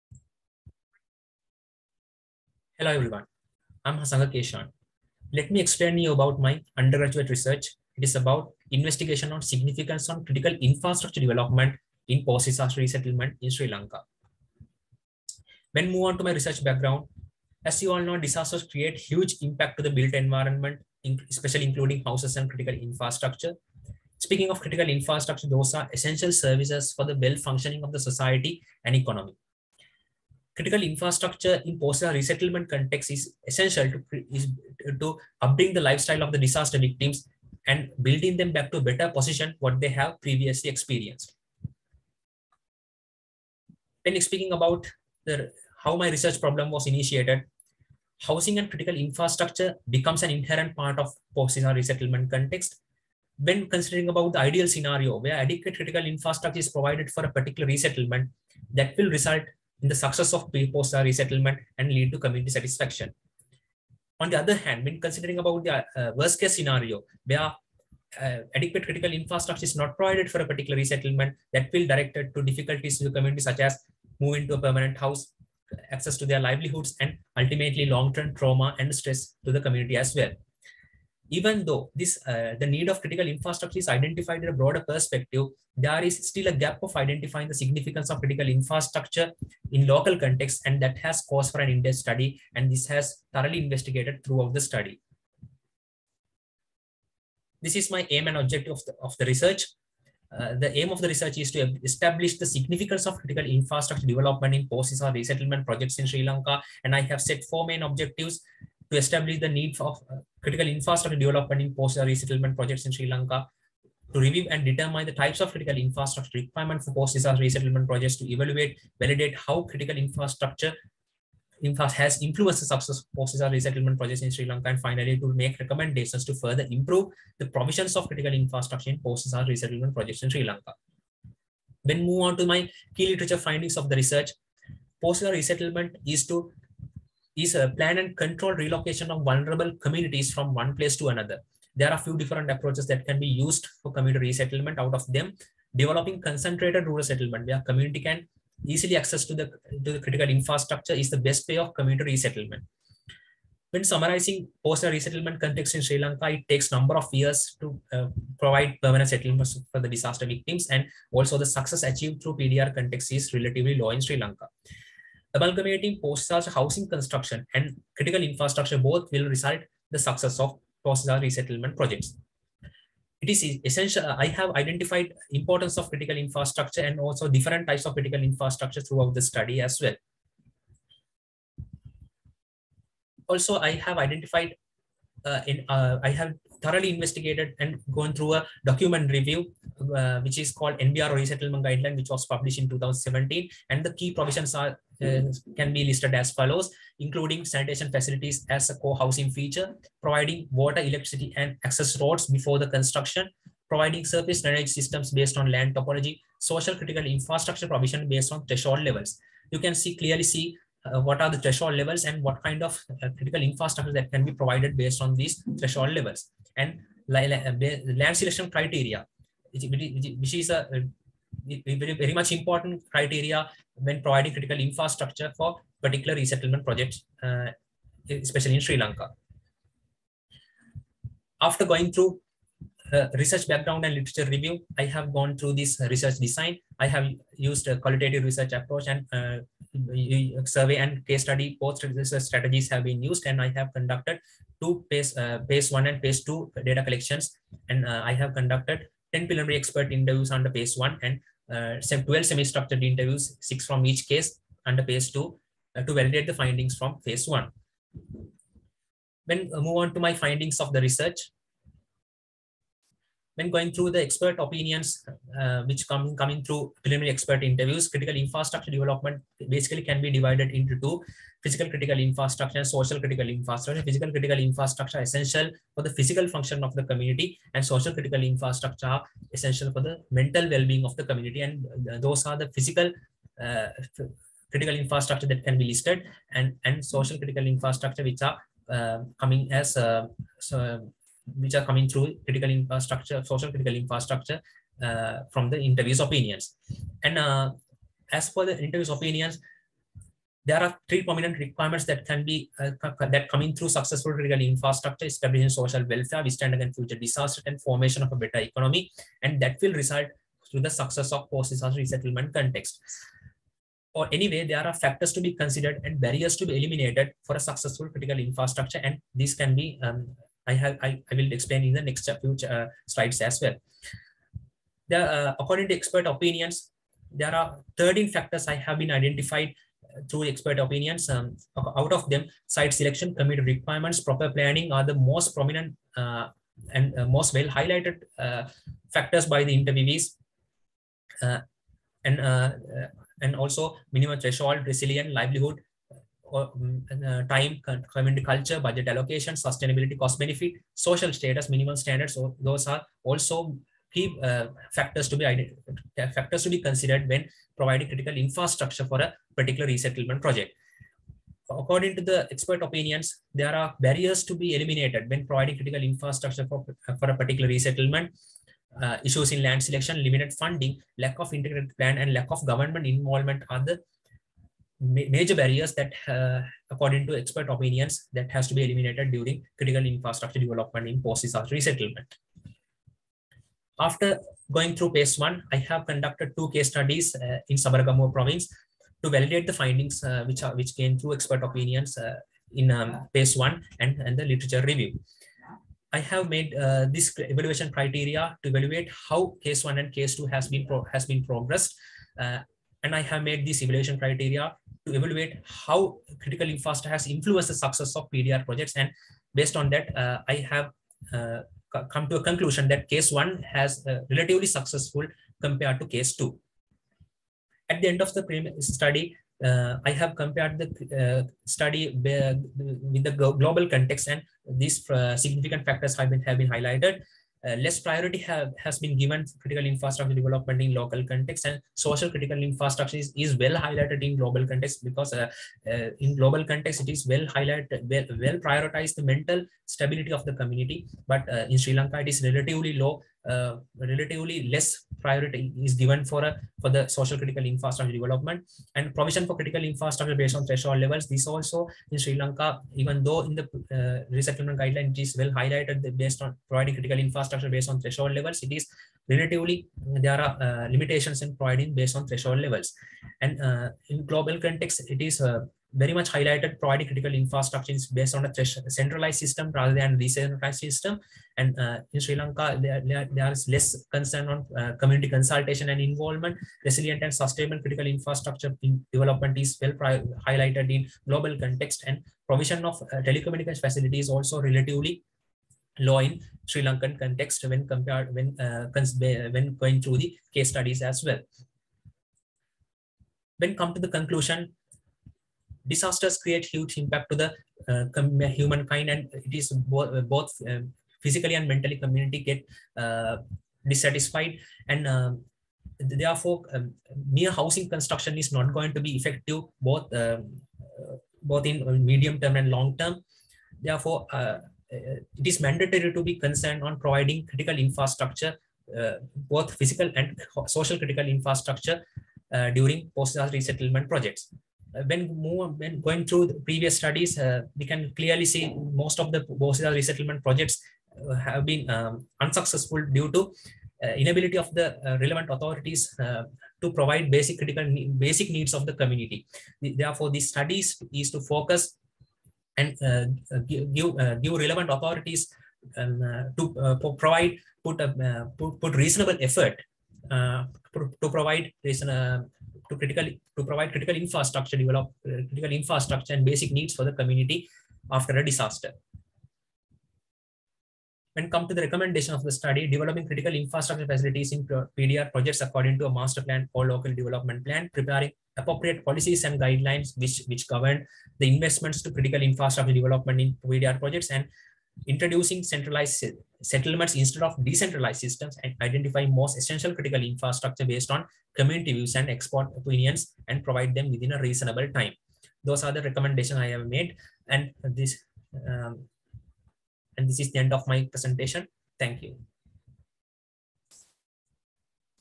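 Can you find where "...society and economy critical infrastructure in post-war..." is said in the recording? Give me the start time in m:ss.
0:27.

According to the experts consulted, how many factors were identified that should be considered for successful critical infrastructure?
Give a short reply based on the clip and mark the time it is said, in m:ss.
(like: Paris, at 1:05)
13, at 5:27.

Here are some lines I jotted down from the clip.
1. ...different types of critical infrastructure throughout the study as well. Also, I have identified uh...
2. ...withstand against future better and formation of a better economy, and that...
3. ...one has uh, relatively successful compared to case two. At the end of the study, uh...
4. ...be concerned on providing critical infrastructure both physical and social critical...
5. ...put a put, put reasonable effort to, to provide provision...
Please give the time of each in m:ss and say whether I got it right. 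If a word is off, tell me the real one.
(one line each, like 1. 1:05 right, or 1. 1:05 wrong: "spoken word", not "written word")
1. 2:57 right
2. 5:06 wrong: "disaster", not "better"
3. 6:53 right
4. 8:36 right
5. 9:07 wrong: "reason", not "provision".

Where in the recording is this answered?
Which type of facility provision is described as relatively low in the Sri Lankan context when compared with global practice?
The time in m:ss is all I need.
8:02.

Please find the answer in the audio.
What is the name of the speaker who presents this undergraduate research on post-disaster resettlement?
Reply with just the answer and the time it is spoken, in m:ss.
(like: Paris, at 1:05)
Hasanga Keshan, at 0:03.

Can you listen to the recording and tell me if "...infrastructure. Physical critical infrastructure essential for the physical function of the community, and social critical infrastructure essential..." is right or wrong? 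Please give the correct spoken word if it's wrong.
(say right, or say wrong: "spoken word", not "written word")
right.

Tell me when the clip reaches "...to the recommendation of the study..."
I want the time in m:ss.
9:21.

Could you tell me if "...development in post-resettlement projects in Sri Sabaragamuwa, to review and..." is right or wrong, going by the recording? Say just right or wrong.
wrong.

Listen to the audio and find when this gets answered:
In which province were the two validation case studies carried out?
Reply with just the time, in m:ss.
6:27.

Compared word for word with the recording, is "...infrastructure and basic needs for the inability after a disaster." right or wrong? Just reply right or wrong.
wrong.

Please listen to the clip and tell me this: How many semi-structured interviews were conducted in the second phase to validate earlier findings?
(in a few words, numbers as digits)
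12.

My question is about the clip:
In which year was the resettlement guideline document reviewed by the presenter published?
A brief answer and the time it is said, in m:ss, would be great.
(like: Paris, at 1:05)
2017, at 3:12.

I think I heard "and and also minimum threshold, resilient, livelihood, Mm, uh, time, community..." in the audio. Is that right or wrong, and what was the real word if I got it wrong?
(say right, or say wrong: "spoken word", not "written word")
right.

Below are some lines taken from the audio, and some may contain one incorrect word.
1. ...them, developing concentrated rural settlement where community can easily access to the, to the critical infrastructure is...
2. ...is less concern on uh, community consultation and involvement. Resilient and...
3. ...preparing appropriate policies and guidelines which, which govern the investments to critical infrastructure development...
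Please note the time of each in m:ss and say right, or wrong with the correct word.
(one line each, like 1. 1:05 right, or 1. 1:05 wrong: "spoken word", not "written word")
1. 2:25 right
2. 7:53 right
3. 9:27 right.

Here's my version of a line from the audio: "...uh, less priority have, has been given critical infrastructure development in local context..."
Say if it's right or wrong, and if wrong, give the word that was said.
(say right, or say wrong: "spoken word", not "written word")
right.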